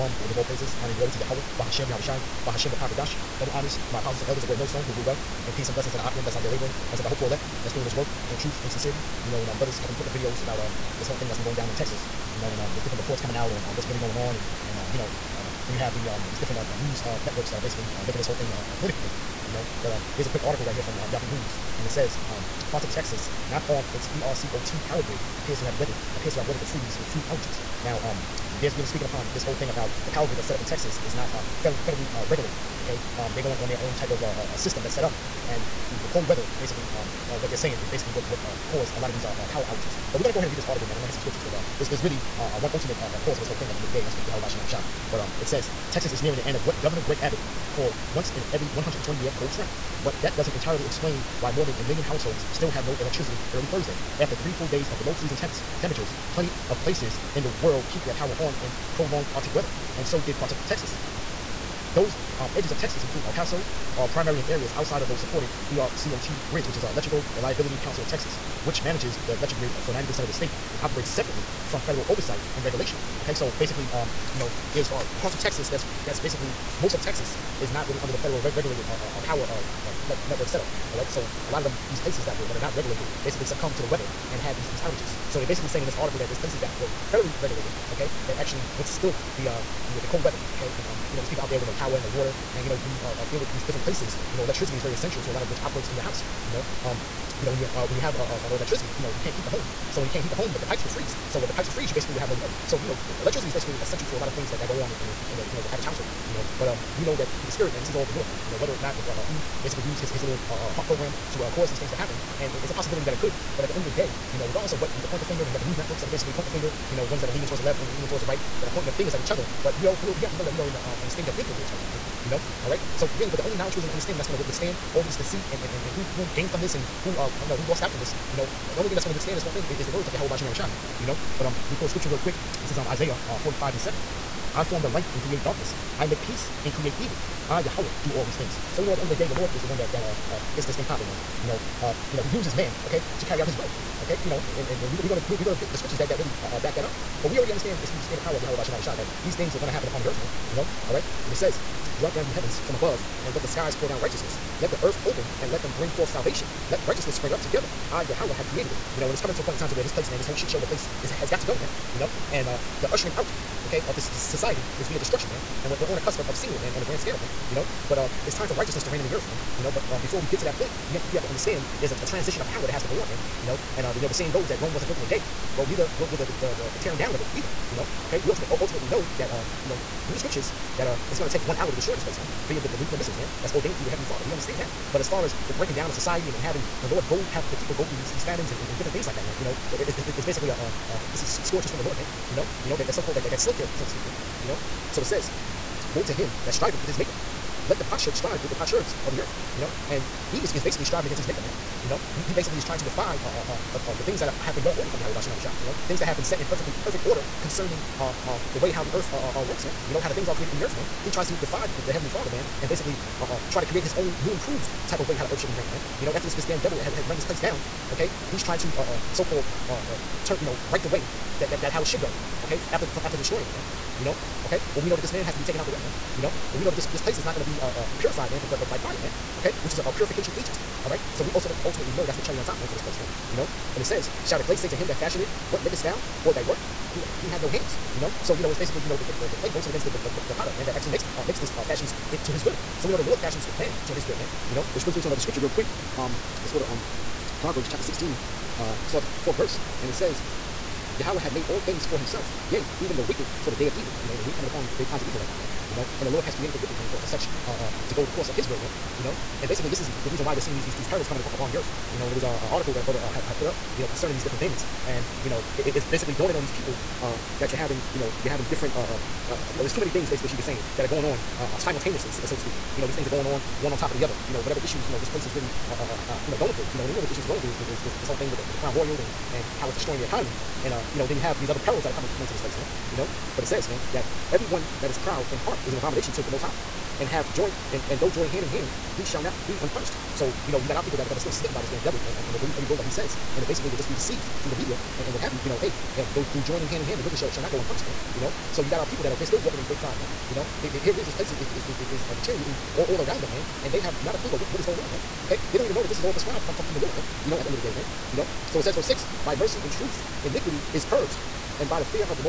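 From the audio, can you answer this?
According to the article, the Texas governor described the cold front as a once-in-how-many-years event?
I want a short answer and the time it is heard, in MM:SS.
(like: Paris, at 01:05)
120, at 00:48.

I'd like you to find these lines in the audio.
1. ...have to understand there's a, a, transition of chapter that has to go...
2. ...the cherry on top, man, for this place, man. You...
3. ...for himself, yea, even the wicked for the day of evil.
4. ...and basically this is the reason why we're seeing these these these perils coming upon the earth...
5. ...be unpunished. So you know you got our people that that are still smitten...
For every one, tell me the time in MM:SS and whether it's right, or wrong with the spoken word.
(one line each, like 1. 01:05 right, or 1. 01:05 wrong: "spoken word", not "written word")
1. 02:51 wrong: "power", not "chapter"
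2. 03:52 right
3. 04:11 right
4. 04:19 right
5. 04:49 right.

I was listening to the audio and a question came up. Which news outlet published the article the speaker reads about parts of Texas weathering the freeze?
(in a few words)
Yahoo News.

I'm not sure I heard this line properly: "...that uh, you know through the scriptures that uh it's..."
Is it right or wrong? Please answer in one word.
right.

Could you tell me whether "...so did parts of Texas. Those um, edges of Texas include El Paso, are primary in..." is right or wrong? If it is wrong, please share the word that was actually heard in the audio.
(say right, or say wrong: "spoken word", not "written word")
right.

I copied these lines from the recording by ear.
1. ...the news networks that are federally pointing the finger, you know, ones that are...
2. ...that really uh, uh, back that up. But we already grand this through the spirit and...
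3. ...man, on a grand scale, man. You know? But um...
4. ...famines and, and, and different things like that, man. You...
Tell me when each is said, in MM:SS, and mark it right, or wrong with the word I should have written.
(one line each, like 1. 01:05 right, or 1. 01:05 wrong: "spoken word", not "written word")
1. 01:55 wrong: "basically", not "federally"
2. 02:26 wrong: "understand", not "grand"
3. 02:46 right
4. 03:08 right.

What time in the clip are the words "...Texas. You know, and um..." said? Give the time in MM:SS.
00:11.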